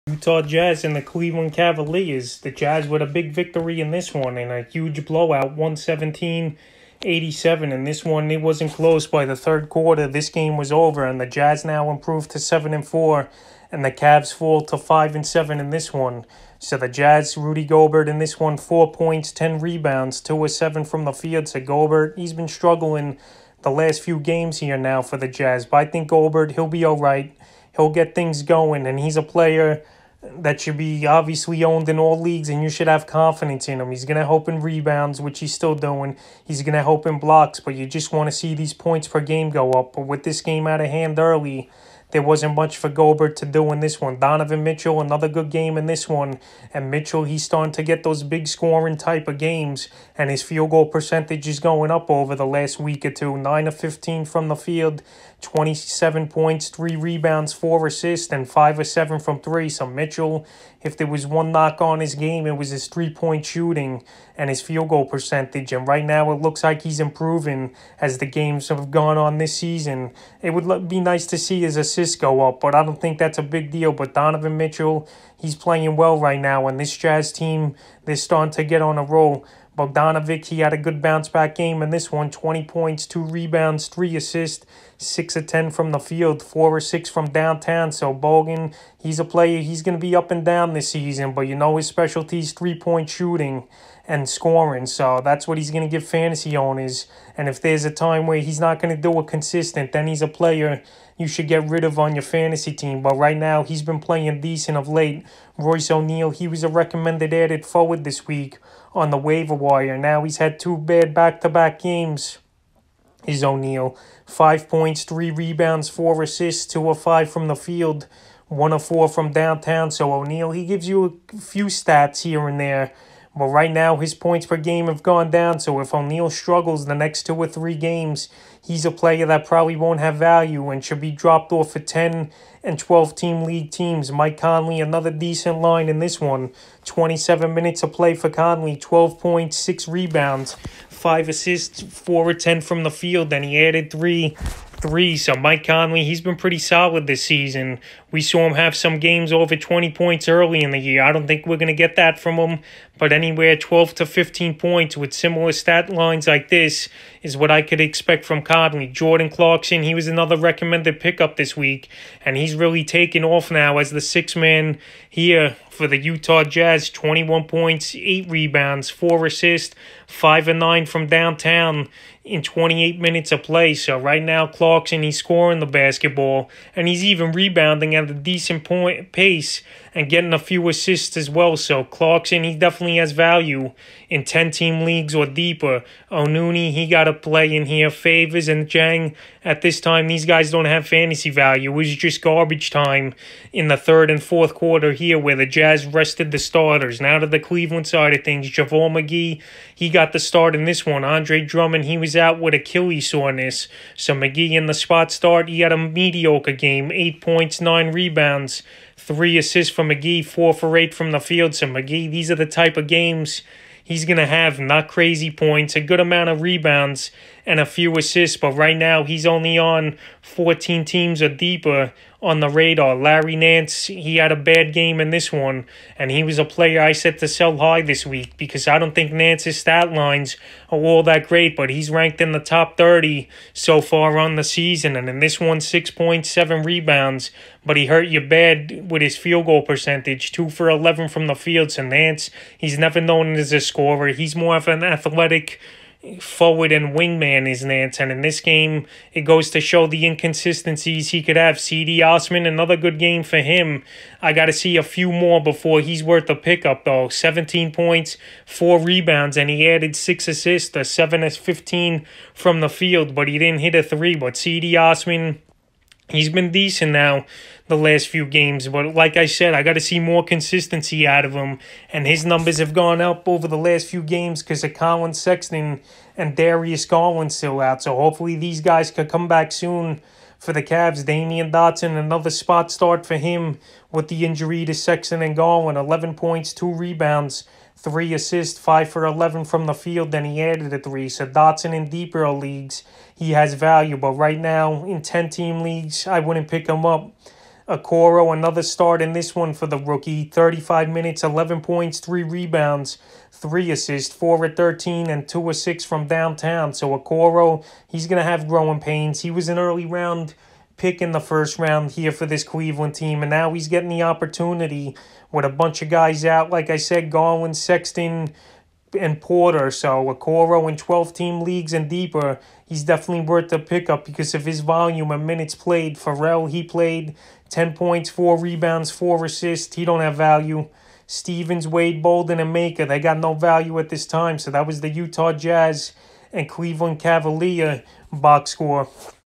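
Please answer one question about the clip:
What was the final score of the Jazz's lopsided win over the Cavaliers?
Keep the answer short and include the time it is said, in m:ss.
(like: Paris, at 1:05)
117-87, at 0:05.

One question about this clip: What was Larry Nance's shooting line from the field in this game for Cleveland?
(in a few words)
2 for 11.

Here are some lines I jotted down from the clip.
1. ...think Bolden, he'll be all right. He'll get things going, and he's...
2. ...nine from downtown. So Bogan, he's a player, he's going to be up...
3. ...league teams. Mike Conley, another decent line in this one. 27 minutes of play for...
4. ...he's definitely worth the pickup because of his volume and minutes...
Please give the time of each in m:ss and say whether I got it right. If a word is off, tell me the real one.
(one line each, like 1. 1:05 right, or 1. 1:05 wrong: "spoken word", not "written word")
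1. 0:25 wrong: "Gobert", not "Bolden"
2. 1:26 wrong: "six", not "nine"
3. 2:13 right
4. 5:22 right.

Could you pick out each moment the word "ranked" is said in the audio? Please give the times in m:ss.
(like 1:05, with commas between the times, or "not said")
3:51.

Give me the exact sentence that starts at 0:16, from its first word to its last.
So the Jazz, Rudy Gobert in this one, 4 points, 10 rebounds, 2 or 7 from the field.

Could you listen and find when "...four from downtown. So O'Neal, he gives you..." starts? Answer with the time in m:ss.
1:58.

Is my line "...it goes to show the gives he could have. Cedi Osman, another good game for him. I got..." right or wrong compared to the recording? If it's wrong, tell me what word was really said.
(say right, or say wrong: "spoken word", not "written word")
wrong: "inconsistencies", not "gives".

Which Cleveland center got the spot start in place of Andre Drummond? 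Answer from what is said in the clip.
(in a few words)
JaVale McGee.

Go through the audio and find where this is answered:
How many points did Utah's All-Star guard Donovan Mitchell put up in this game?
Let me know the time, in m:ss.
0:55.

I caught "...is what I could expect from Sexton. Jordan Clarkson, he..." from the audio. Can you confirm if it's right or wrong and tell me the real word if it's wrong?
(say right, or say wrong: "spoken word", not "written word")
wrong: "Conley", not "Sexton".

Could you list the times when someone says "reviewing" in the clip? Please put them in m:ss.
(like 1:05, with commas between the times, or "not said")
not said.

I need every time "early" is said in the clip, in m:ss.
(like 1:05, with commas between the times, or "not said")
0:41, 2:30, 5:09.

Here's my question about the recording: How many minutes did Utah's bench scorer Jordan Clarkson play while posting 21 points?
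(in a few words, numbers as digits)
28.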